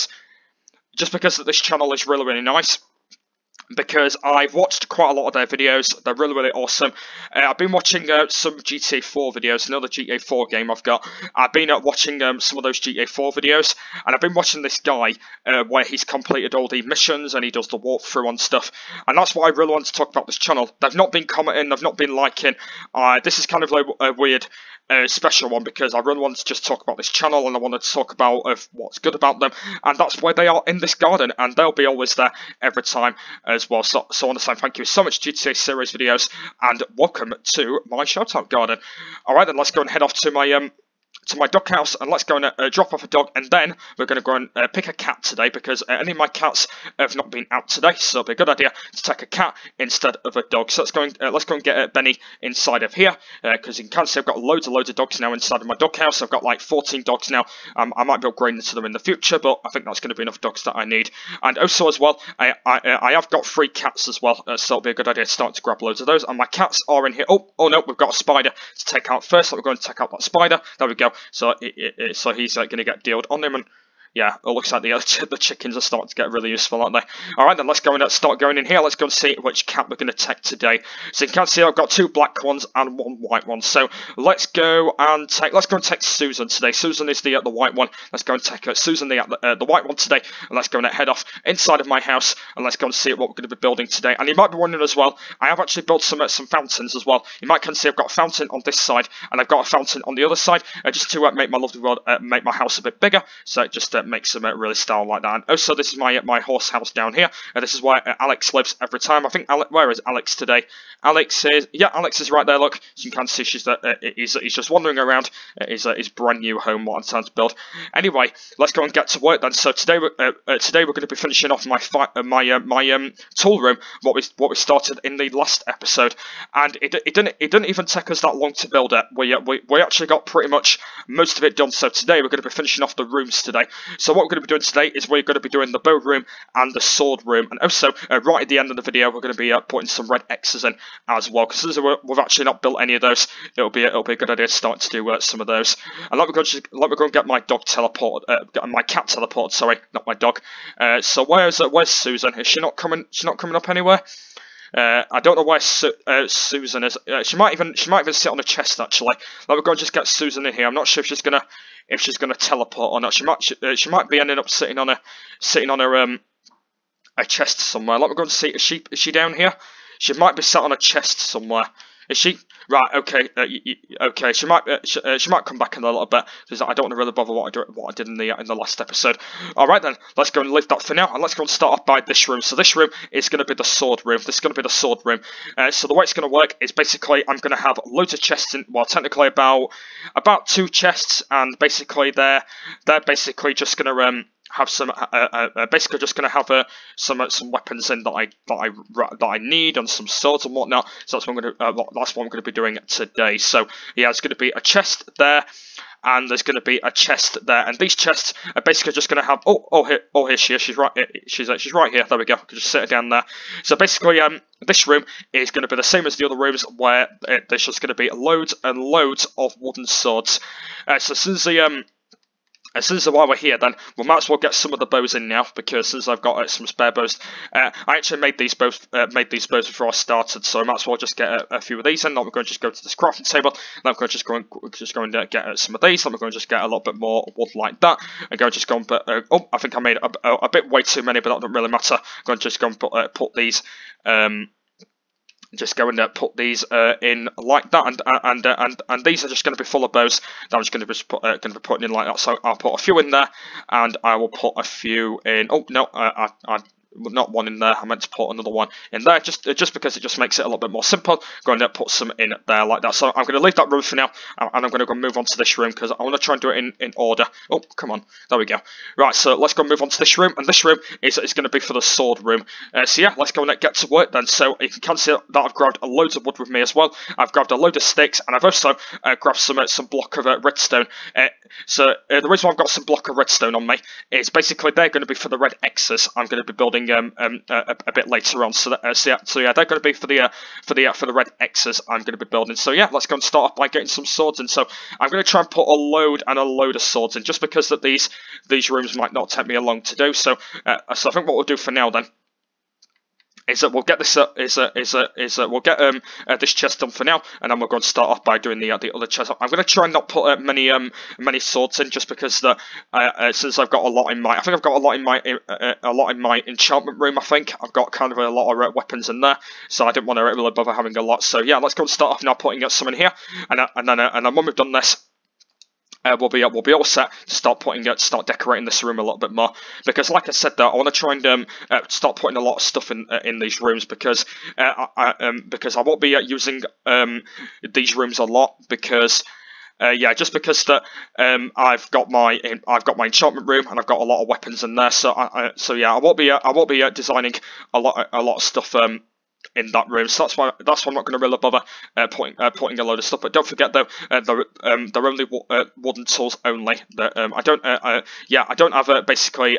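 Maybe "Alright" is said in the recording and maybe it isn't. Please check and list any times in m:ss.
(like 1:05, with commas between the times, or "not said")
0:39.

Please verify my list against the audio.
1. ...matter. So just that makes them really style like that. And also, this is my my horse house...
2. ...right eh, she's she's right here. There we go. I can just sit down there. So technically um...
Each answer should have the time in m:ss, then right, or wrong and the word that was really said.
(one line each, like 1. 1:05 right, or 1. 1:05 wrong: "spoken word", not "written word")
1. 1:42 wrong: "bigger", not "matter"
2. 3:30 wrong: "basically", not "technically".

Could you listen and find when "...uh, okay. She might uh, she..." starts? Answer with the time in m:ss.
2:53.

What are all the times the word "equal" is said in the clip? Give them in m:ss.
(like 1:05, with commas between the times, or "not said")
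not said.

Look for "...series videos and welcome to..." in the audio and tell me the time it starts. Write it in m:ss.
0:35.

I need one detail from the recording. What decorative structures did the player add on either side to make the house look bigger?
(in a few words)
Fountains.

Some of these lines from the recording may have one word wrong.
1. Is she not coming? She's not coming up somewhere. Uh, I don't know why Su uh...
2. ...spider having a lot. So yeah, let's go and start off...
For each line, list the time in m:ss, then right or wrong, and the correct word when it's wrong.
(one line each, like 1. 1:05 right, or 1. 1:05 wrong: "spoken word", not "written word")
1. 2:32 wrong: "anywhere", not "somewhere"
2. 5:20 wrong: "bother", not "spider".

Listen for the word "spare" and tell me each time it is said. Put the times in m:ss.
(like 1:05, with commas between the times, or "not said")
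3:46.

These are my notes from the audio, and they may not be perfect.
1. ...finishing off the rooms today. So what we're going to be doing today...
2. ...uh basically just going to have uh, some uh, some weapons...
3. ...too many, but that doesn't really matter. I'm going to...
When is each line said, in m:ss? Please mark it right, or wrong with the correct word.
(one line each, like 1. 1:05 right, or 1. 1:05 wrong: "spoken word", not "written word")
1. 2:12 right
2. 3:15 right
3. 4:00 right.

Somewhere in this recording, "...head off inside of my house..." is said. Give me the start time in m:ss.
1:30.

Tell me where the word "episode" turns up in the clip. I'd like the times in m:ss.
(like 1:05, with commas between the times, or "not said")
2:05, 2:58.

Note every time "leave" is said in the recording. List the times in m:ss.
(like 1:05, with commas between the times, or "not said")
3:00, 4:23.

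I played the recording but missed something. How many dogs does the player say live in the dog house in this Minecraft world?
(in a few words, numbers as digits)
14.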